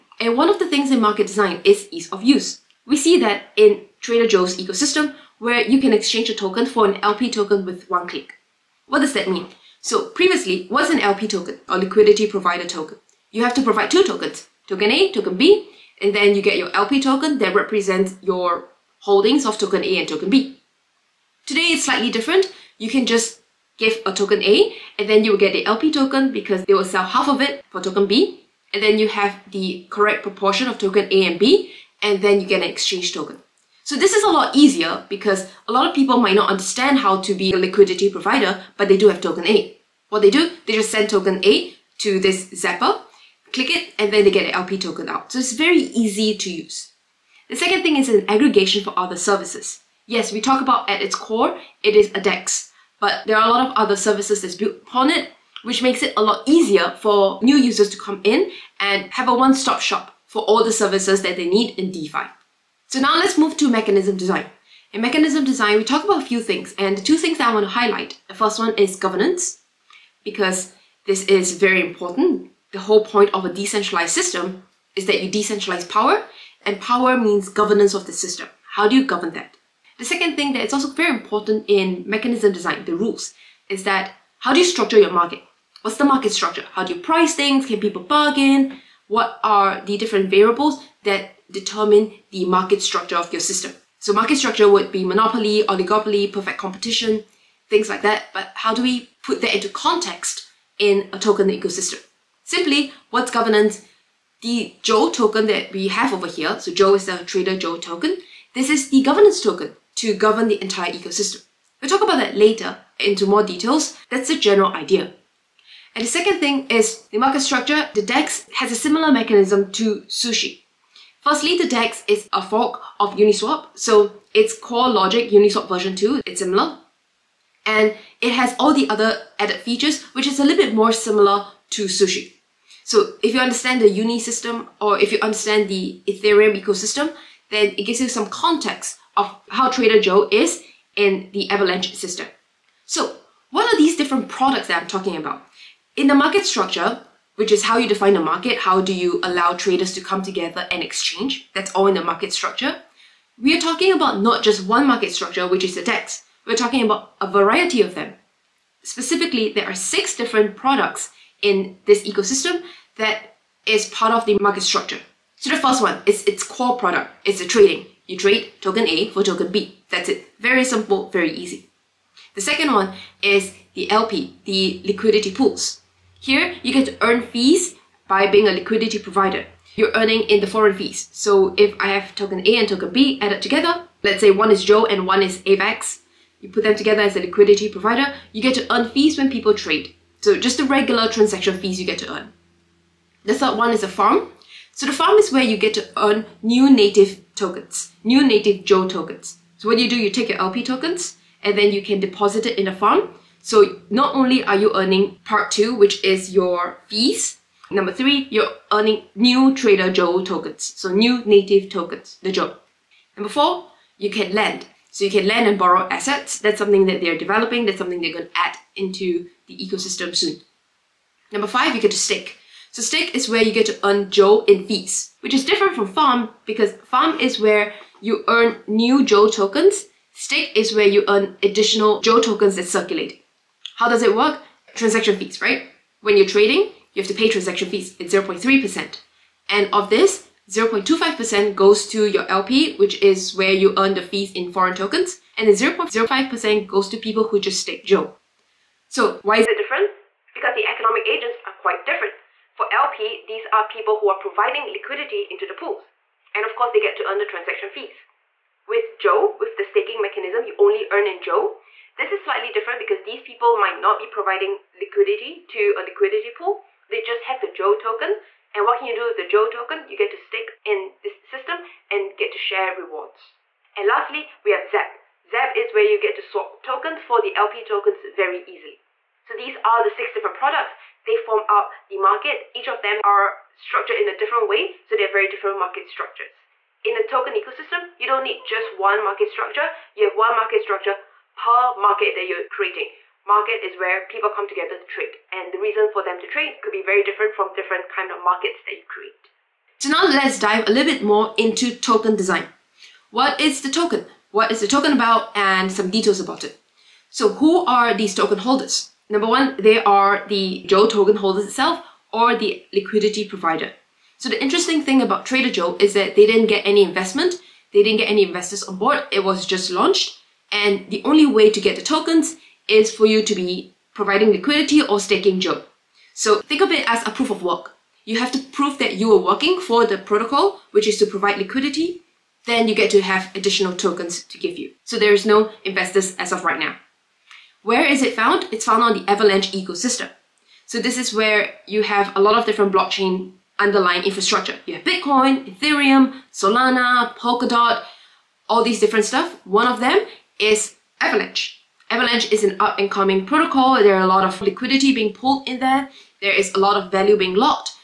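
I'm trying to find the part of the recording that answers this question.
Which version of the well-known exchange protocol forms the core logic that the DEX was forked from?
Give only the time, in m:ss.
2:05.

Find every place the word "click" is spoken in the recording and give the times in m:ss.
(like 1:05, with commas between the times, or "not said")
0:08, 0:43.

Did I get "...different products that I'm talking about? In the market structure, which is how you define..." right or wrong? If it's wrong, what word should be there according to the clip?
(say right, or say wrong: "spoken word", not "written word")
right.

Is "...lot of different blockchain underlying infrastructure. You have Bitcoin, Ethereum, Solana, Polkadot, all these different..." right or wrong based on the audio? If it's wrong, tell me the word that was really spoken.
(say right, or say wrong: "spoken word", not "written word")
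right.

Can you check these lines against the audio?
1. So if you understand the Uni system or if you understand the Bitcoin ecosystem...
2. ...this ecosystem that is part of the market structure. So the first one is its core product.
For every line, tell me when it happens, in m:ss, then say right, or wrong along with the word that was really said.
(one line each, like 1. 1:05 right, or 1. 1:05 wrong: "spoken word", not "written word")
1. 2:12 wrong: "Ethereum", not "Bitcoin"
2. 2:41 right.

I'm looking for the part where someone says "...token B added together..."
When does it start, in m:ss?
3:02.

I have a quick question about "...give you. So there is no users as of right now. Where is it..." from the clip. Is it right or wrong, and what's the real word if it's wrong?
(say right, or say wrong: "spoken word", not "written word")
wrong: "investors", not "users".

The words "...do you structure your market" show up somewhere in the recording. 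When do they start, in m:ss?
1:24.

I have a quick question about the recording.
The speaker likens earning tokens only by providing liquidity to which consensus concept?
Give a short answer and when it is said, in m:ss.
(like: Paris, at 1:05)
proof of work, at 5:27.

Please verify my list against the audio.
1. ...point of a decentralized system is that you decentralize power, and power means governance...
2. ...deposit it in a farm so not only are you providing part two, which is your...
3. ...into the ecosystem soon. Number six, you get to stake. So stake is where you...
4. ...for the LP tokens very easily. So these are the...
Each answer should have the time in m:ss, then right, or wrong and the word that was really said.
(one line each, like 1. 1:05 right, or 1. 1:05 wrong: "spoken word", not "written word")
1. 1:13 right
2. 3:21 wrong: "earning", not "providing"
3. 3:38 wrong: "five", not "six"
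4. 4:37 right.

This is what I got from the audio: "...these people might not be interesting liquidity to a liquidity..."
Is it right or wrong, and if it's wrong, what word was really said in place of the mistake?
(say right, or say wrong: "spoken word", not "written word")
wrong: "providing", not "interesting".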